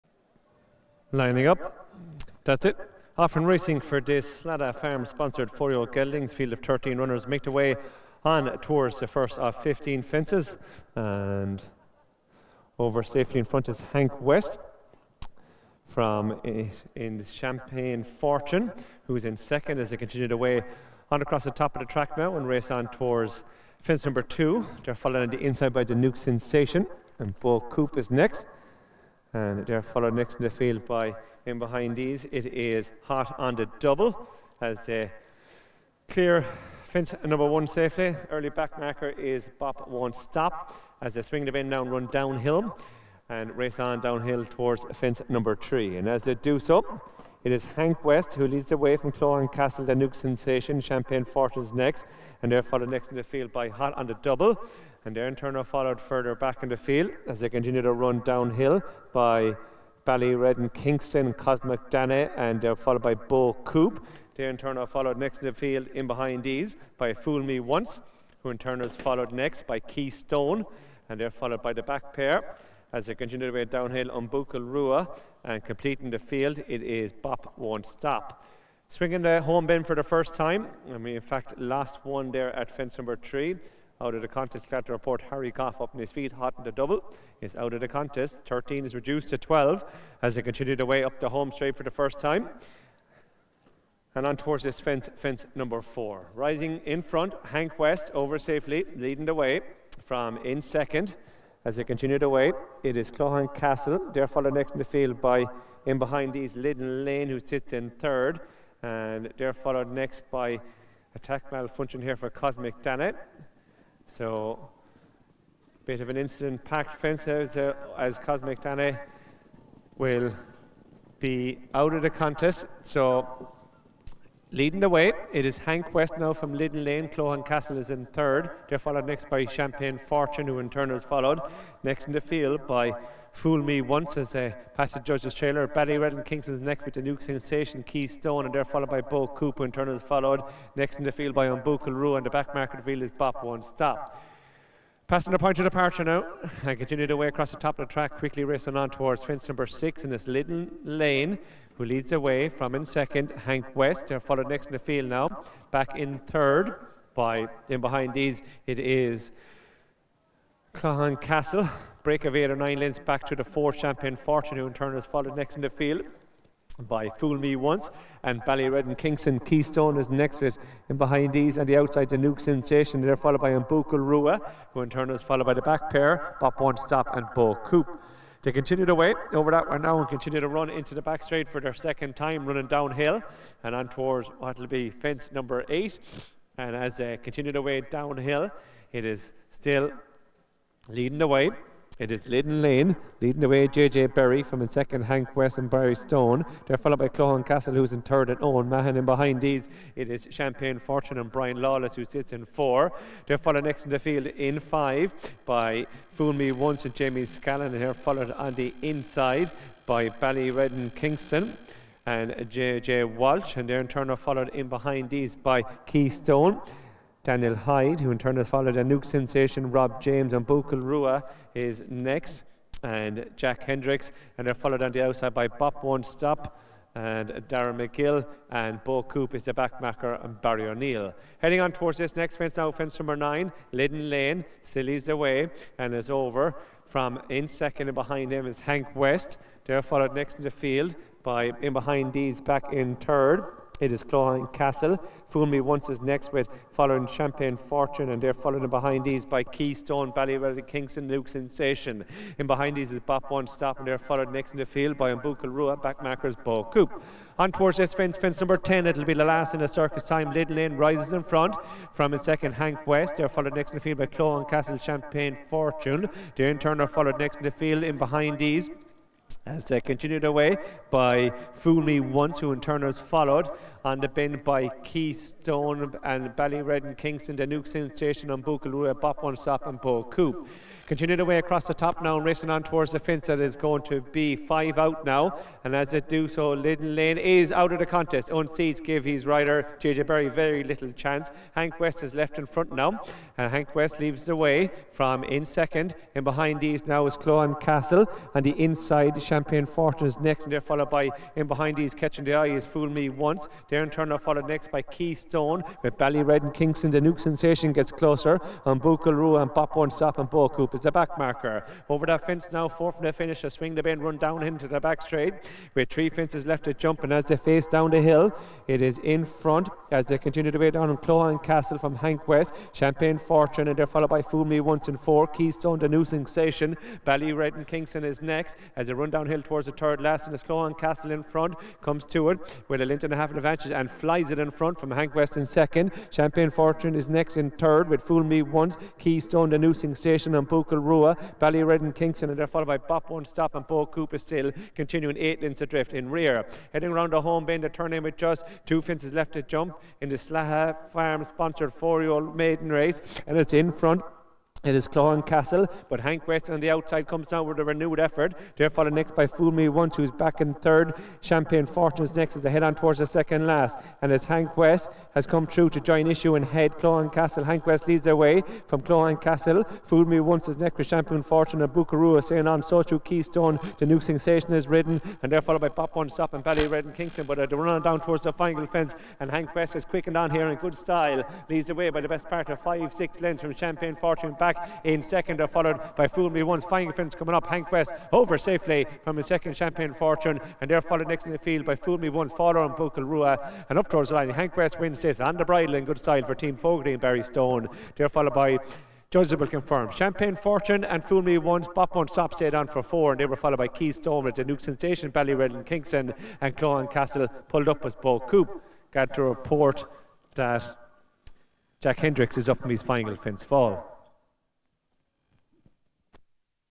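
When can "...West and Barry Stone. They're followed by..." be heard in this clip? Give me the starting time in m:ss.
3:15.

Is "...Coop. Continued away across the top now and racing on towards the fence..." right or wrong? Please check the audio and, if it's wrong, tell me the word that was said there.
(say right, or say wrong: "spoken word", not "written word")
right.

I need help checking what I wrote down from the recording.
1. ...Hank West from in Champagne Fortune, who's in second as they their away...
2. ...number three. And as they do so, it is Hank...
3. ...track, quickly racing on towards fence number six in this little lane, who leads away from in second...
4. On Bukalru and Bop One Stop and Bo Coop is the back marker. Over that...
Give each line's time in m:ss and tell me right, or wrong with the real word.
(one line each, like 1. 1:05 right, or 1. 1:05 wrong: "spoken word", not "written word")
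1. 0:13 right
2. 0:45 right
3. 2:27 right
4. 5:08 right.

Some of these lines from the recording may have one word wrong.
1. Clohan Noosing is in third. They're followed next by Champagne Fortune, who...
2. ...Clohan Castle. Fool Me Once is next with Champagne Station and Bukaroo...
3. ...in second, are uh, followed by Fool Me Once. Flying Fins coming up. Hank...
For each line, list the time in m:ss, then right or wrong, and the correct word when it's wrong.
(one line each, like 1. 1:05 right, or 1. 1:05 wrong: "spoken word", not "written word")
1. 2:07 wrong: "Castle", not "Noosing"
2. 6:08 wrong: "Fortune", not "Station"
3. 6:24 right.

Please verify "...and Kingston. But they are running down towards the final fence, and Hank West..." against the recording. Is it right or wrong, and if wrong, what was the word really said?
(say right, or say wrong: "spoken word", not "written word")
right.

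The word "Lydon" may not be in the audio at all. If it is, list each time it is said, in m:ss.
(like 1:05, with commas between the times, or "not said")
1:46, 3:53.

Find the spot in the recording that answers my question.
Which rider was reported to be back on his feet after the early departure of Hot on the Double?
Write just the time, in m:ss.
1:25.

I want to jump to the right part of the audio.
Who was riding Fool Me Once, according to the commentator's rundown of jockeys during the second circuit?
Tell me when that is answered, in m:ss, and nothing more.
3:26.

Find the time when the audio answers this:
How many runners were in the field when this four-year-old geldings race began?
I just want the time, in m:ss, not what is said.
0:06.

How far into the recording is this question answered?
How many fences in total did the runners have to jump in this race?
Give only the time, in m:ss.
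0:09.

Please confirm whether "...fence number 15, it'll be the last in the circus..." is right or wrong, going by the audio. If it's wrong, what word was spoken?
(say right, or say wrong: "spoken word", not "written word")
wrong: "10", not "15".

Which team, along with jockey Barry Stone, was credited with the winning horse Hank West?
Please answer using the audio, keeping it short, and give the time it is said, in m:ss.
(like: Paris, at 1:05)
Team Fogarty, at 6:36.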